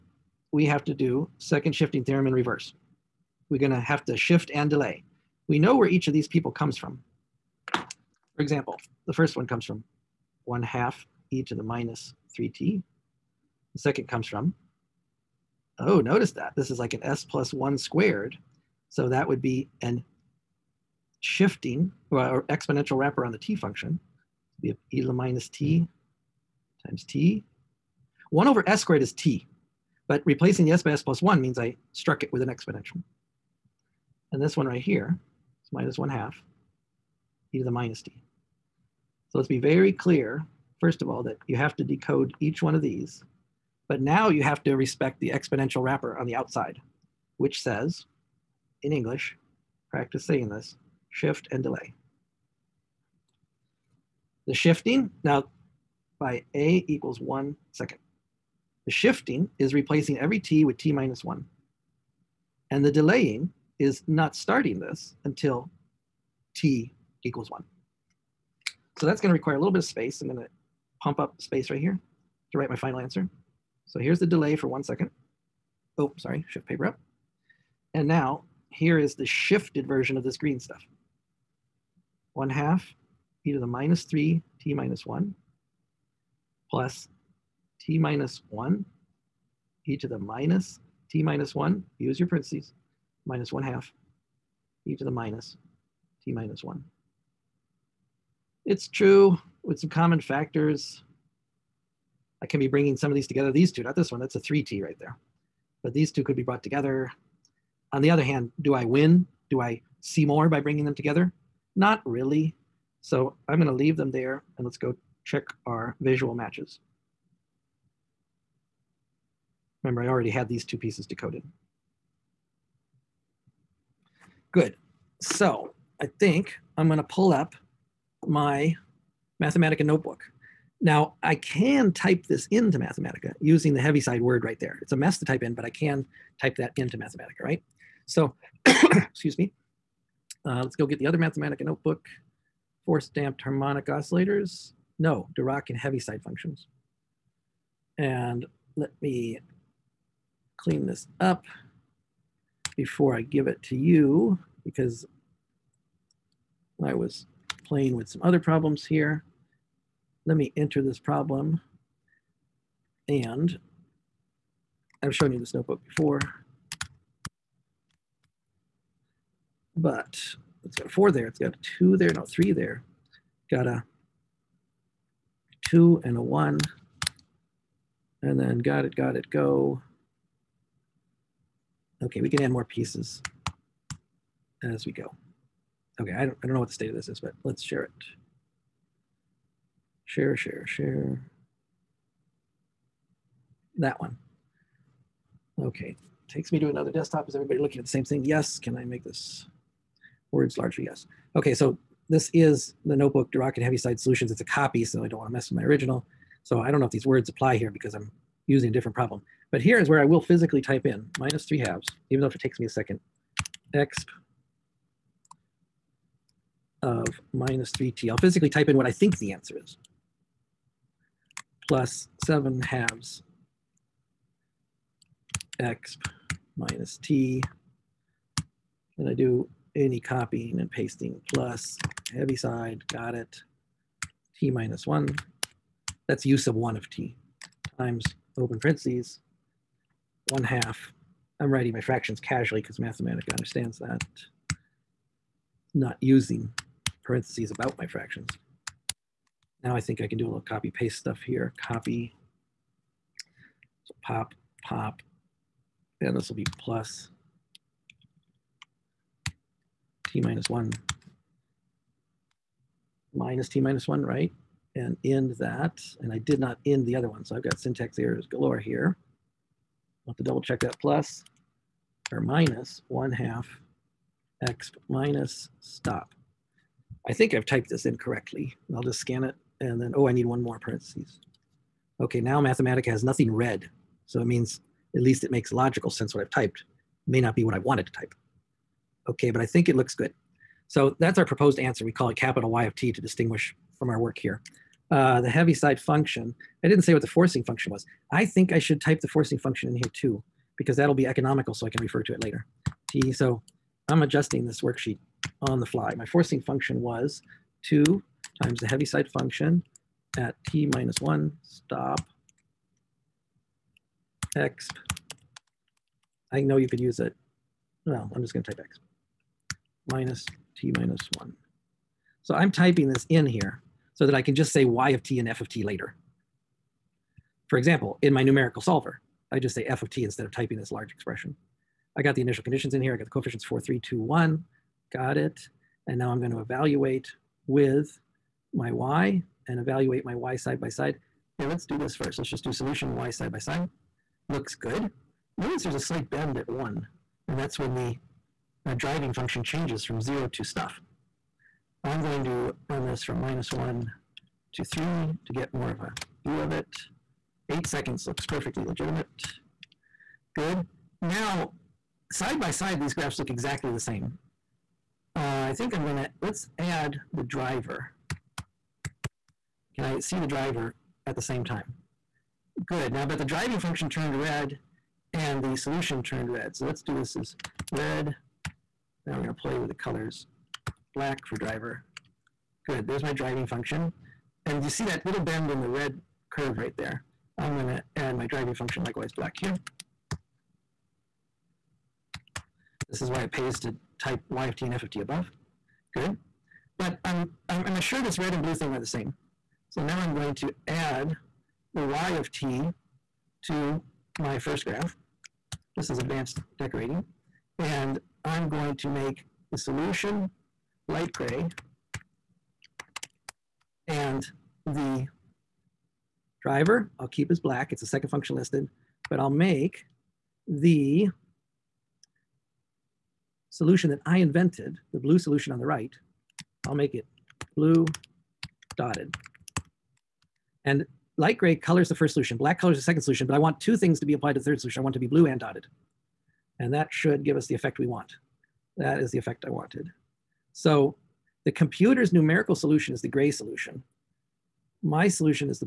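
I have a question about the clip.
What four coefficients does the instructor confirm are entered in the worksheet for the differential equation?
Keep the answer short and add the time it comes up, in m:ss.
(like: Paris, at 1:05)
4, 3, 2, 1, at 5:33.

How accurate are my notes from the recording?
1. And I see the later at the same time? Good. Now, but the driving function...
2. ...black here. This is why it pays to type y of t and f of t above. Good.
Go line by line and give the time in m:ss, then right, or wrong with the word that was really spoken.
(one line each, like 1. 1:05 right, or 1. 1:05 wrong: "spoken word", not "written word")
1. 6:09 wrong: "driver", not "later"
2. 6:29 right.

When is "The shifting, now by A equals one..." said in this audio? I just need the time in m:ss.
0:54.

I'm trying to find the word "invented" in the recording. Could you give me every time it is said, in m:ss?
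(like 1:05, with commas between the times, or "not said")
7:04.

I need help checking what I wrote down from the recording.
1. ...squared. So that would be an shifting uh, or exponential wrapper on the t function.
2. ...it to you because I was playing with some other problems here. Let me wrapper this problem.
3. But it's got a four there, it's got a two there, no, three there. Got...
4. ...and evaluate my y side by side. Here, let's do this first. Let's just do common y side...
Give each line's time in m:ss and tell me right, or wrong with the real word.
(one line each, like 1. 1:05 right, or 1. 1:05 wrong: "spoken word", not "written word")
1. 0:17 right
2. 2:33 wrong: "enter", not "wrapper"
3. 2:49 right
4. 5:39 wrong: "solution", not "common".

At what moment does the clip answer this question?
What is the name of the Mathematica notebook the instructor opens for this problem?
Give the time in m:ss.
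3:23.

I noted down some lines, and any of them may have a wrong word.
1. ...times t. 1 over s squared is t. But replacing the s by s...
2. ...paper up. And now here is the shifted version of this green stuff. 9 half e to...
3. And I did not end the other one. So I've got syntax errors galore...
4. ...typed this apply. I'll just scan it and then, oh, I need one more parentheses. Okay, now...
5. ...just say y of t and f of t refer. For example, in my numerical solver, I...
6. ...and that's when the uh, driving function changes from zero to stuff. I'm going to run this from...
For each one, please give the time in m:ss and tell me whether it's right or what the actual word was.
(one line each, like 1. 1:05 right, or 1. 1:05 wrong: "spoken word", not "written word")
1. 0:26 right
2. 1:16 wrong: "1", not "9"
3. 4:25 right
4. 4:37 wrong: "incorrectly", not "apply"
5. 5:24 wrong: "later", not "refer"
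6. 5:47 right.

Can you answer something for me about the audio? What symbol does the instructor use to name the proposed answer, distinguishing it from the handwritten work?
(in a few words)
capital Y of t.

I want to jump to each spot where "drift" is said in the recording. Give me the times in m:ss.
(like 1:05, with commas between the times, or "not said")
not said.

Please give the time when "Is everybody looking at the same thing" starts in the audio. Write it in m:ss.
3:17.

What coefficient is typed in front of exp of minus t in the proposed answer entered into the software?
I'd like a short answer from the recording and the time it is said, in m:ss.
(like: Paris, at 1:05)
7/2, at 3:42.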